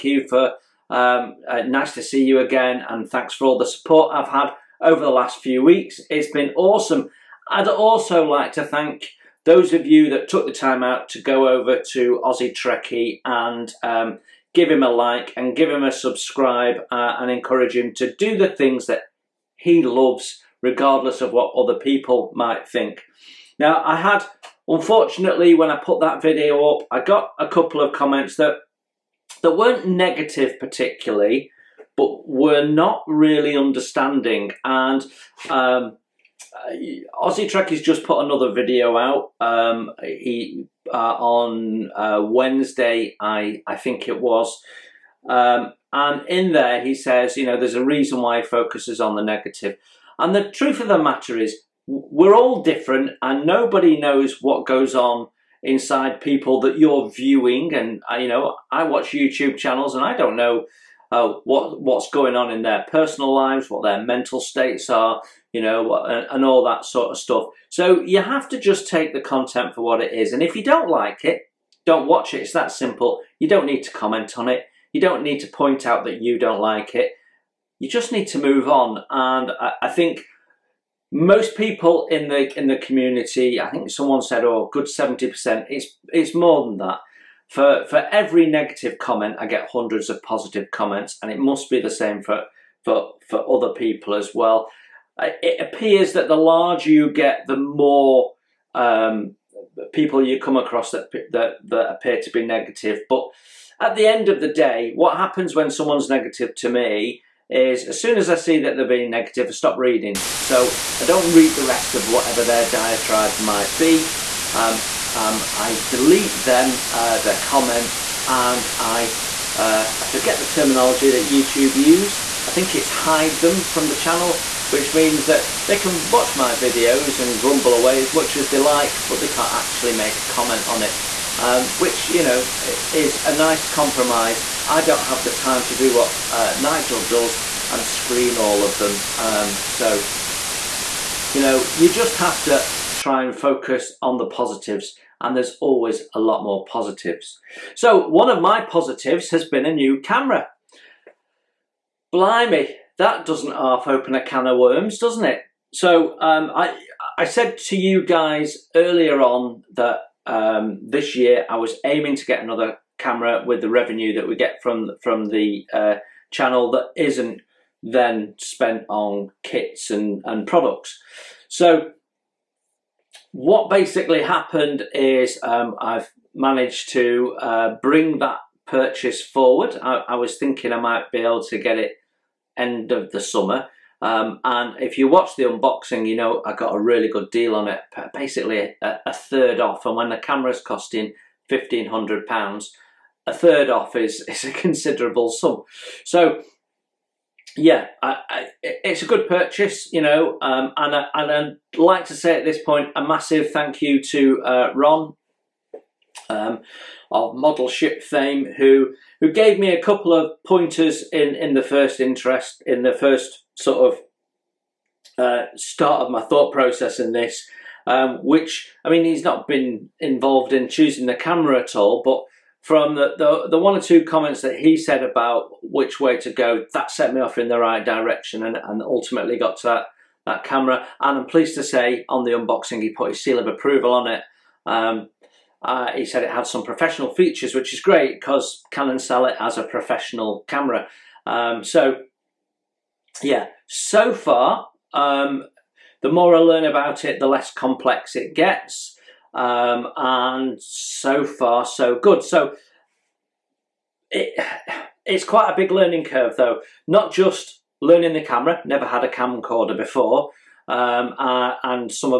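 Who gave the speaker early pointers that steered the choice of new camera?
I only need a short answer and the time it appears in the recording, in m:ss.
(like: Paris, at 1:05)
Ron, at 3:24.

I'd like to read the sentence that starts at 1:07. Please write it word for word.
So you have to just take the content for what it is, and if you don't like it, don't watch it.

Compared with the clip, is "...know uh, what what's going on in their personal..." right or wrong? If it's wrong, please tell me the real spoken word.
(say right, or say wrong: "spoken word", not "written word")
right.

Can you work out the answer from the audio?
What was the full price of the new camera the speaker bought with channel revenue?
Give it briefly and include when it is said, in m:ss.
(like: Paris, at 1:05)
£1,500, at 3:11.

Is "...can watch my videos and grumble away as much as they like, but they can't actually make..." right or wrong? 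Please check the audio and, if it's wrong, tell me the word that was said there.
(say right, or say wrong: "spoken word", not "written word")
right.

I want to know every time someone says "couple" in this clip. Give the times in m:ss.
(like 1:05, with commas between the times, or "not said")
0:27, 3:29.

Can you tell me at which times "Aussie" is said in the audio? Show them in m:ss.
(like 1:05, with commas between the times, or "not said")
0:12, 0:37.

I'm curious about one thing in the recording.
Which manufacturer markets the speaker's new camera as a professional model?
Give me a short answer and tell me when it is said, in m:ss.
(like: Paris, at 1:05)
Canon, at 3:58.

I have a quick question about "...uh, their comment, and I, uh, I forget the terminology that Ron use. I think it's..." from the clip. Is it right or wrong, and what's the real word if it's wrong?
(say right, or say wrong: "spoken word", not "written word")
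wrong: "YouTube", not "Ron".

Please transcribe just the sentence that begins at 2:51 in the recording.
So what basically happened is um, I've managed to uh, bring that purchase forward.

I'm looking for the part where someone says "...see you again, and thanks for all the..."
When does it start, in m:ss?
0:02.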